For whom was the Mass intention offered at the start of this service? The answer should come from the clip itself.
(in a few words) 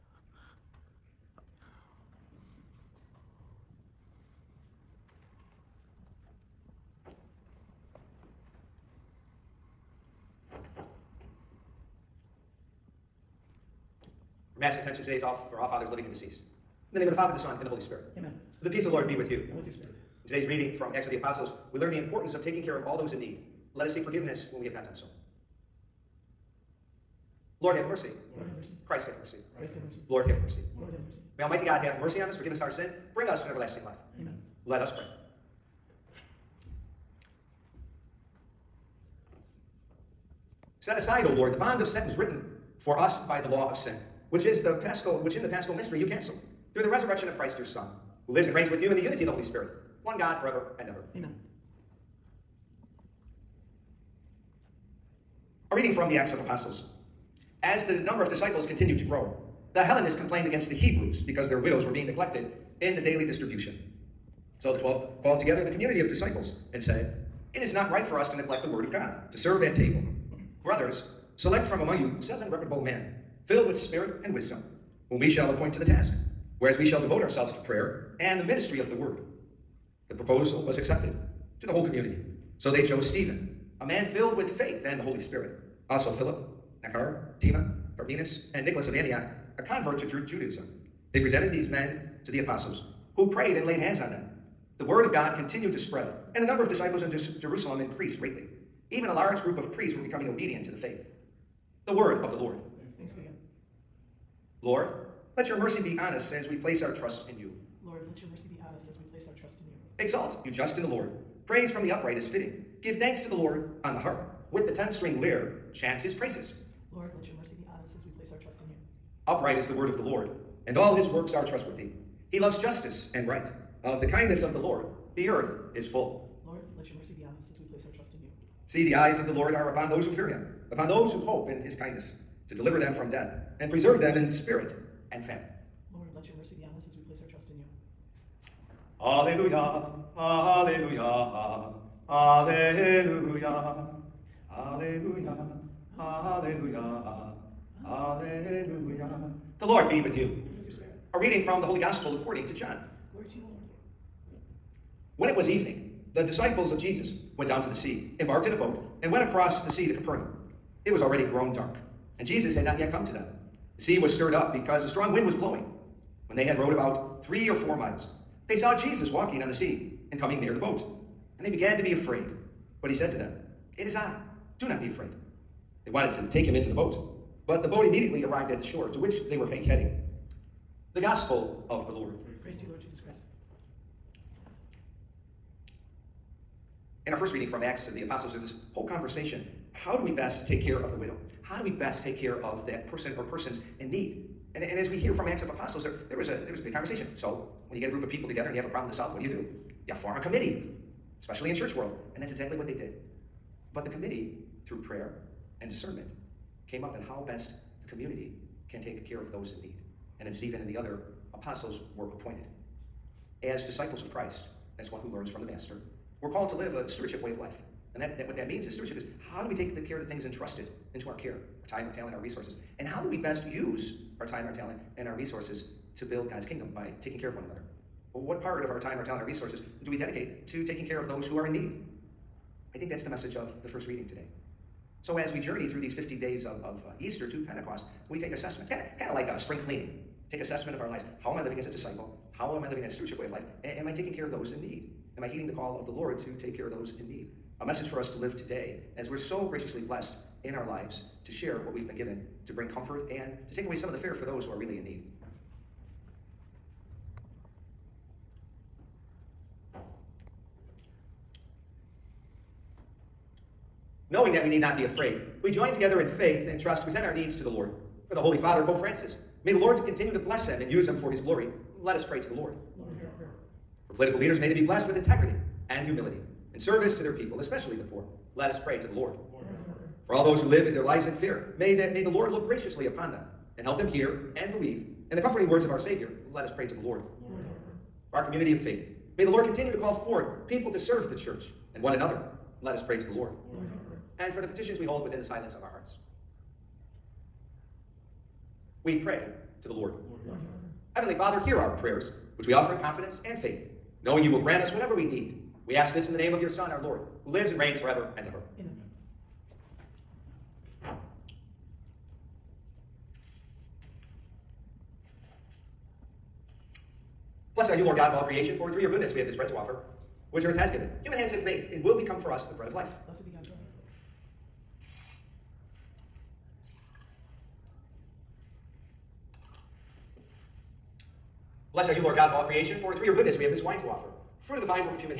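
All fathers living and deceased.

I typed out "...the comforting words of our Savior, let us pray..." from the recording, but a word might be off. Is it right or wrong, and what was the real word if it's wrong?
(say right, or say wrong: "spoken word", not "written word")
right.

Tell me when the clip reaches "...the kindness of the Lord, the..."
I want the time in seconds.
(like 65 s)
124 s.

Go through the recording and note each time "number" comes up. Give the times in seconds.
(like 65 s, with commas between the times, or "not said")
58 s, 96 s.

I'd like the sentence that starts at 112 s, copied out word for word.
Give thanks to the Lord on the harp.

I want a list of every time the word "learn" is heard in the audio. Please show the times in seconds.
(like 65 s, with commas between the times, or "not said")
21 s, 215 s.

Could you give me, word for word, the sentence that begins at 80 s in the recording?
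The proposal was accepted to the whole community.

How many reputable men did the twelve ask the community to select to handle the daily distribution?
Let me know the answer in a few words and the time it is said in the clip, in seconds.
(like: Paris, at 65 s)
7, at 72 s.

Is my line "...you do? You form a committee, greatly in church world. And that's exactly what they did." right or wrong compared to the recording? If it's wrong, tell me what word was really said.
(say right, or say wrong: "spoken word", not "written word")
wrong: "especially", not "greatly".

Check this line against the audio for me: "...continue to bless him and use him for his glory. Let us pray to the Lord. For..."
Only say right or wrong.
right.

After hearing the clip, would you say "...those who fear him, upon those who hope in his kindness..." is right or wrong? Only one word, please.
right.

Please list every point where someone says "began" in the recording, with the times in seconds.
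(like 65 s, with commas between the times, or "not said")
171 s.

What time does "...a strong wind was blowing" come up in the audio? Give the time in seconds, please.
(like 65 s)
164 s.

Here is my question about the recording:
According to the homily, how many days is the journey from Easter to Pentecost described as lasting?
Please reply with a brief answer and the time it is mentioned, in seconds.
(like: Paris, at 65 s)
50, at 235 s.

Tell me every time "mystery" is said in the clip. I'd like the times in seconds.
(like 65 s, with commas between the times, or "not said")
45 s.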